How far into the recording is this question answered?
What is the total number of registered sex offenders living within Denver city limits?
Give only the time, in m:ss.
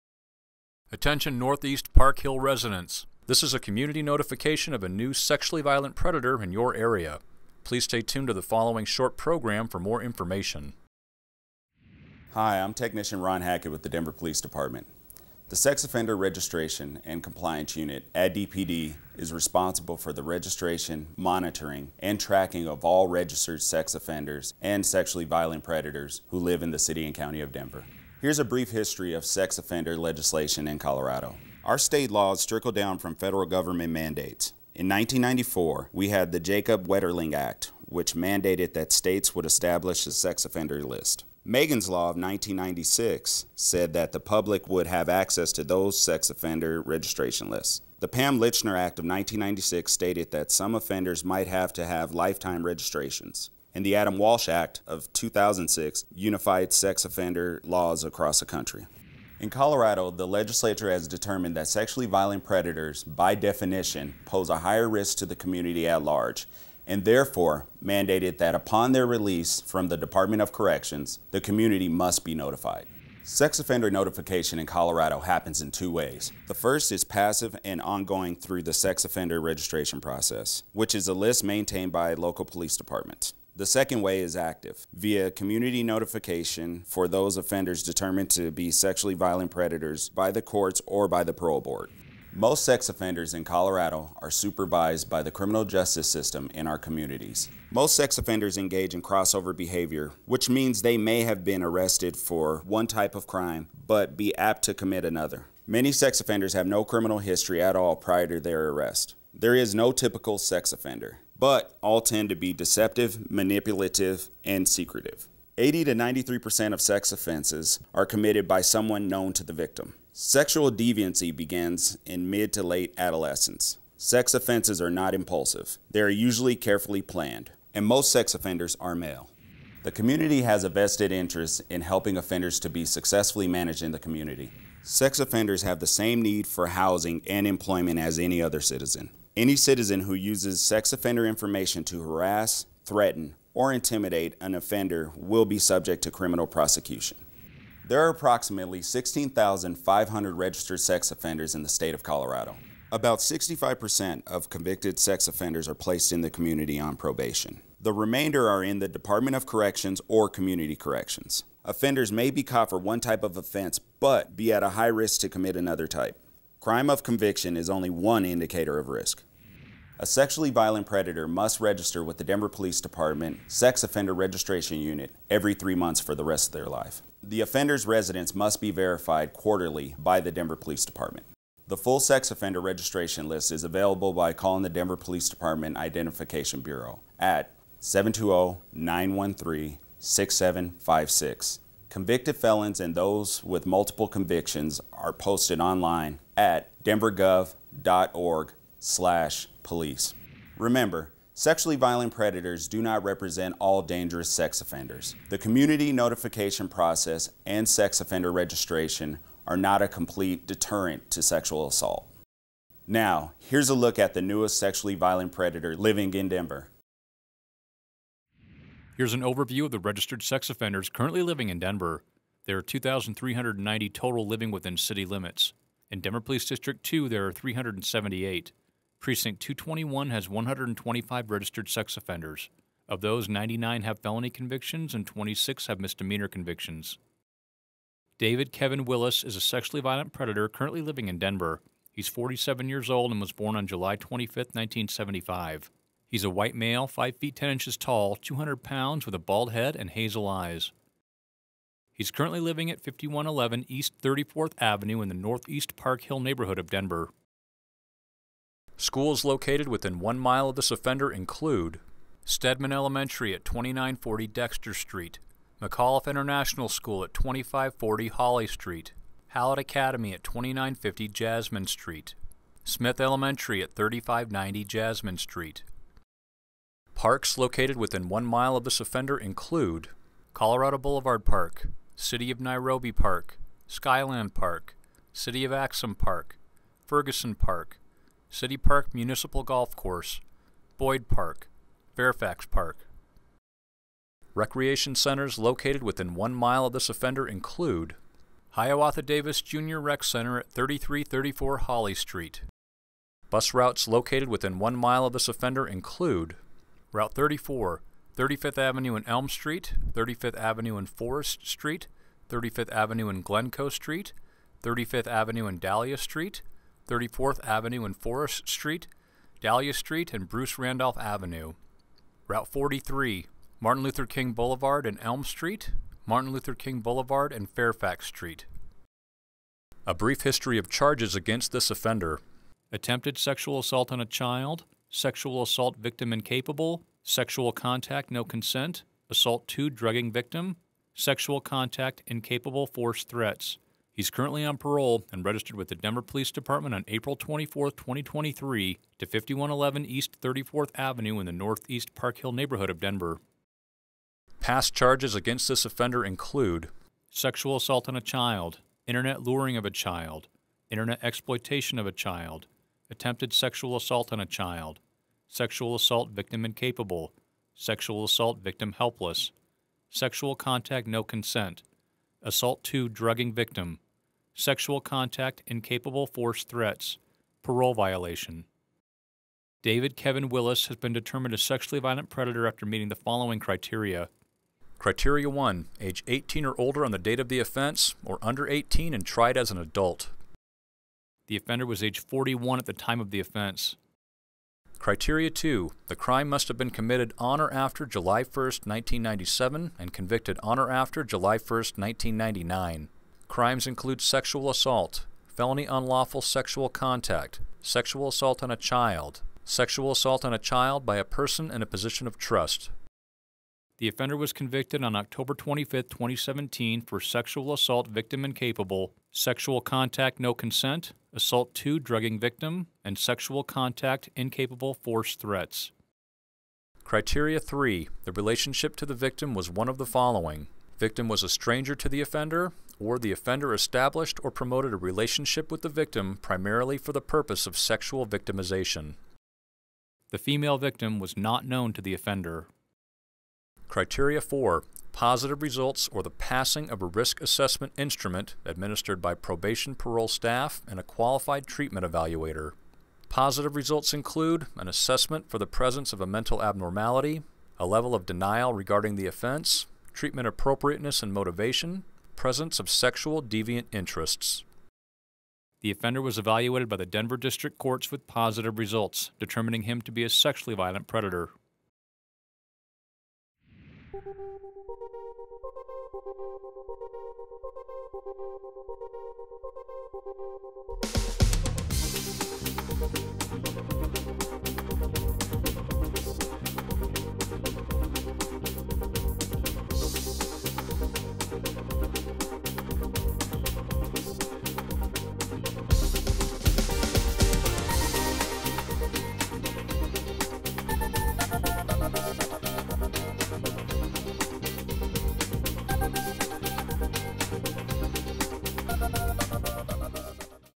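3:42.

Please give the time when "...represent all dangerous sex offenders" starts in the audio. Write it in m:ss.
3:23.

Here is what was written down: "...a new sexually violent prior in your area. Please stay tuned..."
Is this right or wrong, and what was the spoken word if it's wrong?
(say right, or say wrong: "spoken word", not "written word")
wrong: "predator", not "prior".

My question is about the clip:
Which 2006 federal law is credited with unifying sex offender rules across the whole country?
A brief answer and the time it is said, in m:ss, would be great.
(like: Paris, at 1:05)
Adam Walsh Act, at 0:53.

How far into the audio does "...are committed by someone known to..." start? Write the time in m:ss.
1:57.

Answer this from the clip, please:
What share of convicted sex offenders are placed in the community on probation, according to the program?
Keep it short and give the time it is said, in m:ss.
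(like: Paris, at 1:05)
65%, at 2:33.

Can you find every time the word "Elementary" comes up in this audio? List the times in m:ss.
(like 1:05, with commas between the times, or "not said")
4:22, 4:32.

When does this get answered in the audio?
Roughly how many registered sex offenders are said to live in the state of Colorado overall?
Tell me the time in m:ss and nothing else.
2:28.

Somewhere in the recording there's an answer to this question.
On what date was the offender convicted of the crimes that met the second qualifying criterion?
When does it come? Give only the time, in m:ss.
6:54.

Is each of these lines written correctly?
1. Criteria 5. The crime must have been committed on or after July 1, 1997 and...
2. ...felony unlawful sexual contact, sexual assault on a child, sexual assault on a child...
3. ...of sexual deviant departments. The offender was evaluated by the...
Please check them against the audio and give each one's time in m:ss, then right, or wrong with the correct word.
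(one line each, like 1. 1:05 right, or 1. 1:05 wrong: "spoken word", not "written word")
1. 6:34 wrong: "2", not "5"
2. 6:45 right
3. 7:42 wrong: "interests", not "departments".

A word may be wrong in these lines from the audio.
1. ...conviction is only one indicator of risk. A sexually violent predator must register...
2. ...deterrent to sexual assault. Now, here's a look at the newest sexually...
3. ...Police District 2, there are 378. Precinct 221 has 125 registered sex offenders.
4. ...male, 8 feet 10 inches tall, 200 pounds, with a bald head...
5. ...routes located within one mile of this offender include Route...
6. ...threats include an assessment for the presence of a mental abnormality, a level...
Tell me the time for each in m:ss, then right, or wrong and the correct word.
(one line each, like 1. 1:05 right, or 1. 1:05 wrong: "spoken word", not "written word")
1. 2:47 right
2. 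3:30 right
3. 3:46 right
4. 4:06 wrong: "5", not "8"
5. 5:03 right
6. 7:33 wrong: "results", not "threats".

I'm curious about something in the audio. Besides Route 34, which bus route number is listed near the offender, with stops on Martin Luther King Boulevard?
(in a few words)
43.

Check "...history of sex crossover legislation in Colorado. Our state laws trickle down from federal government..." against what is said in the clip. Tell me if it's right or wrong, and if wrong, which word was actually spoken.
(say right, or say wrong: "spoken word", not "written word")
wrong: "offender", not "crossover".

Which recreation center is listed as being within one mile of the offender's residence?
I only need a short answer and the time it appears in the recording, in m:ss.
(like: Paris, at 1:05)
Hiawatha Davis Junior Rec Center, at 4:58.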